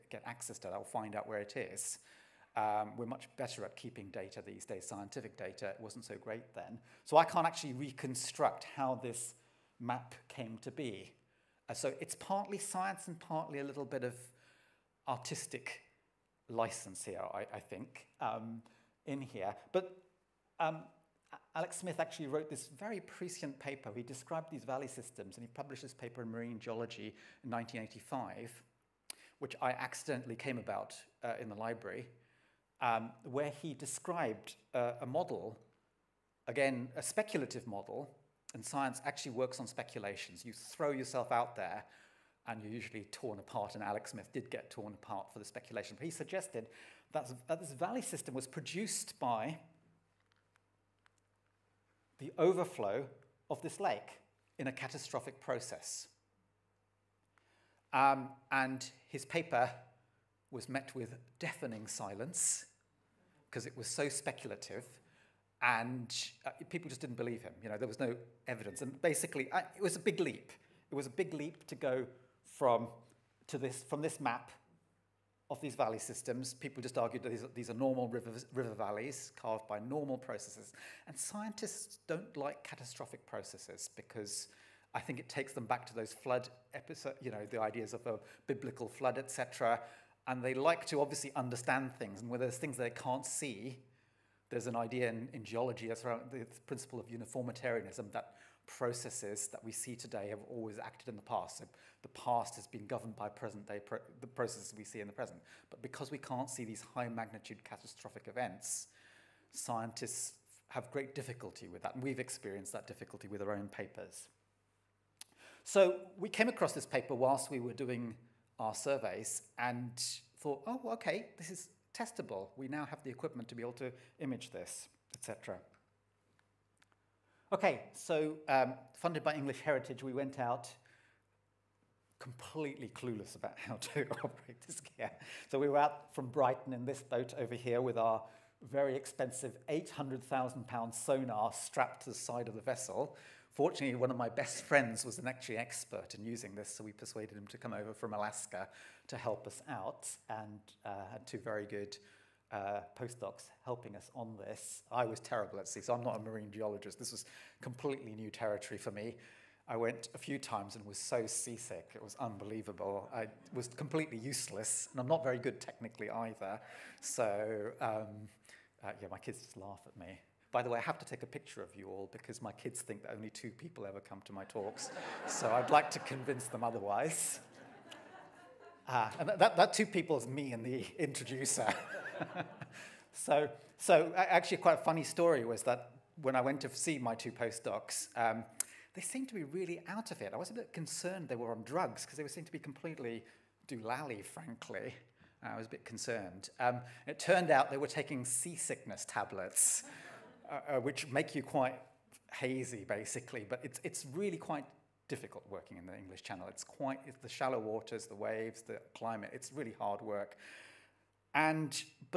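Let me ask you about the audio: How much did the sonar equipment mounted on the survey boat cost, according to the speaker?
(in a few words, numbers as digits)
£800,000.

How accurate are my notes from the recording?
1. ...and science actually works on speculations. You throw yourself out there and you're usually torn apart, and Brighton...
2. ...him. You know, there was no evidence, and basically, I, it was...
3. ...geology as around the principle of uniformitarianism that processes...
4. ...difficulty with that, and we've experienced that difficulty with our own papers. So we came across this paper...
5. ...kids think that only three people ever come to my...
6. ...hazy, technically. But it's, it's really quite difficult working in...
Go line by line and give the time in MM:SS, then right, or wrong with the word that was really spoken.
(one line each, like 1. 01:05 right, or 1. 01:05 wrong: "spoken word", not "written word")
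1. 00:38 wrong: "Alex", not "Brighton"
2. 01:07 right
3. 01:35 right
4. 01:51 right
5. 02:52 wrong: "two", not "three"
6. 03:22 wrong: "basically", not "technically".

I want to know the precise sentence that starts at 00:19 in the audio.
But um, Alex Smith actually wrote this very prescient paper.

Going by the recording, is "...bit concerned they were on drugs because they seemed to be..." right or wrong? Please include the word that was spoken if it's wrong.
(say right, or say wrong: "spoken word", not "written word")
right.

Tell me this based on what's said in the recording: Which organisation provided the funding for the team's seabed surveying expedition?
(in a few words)
English Heritage.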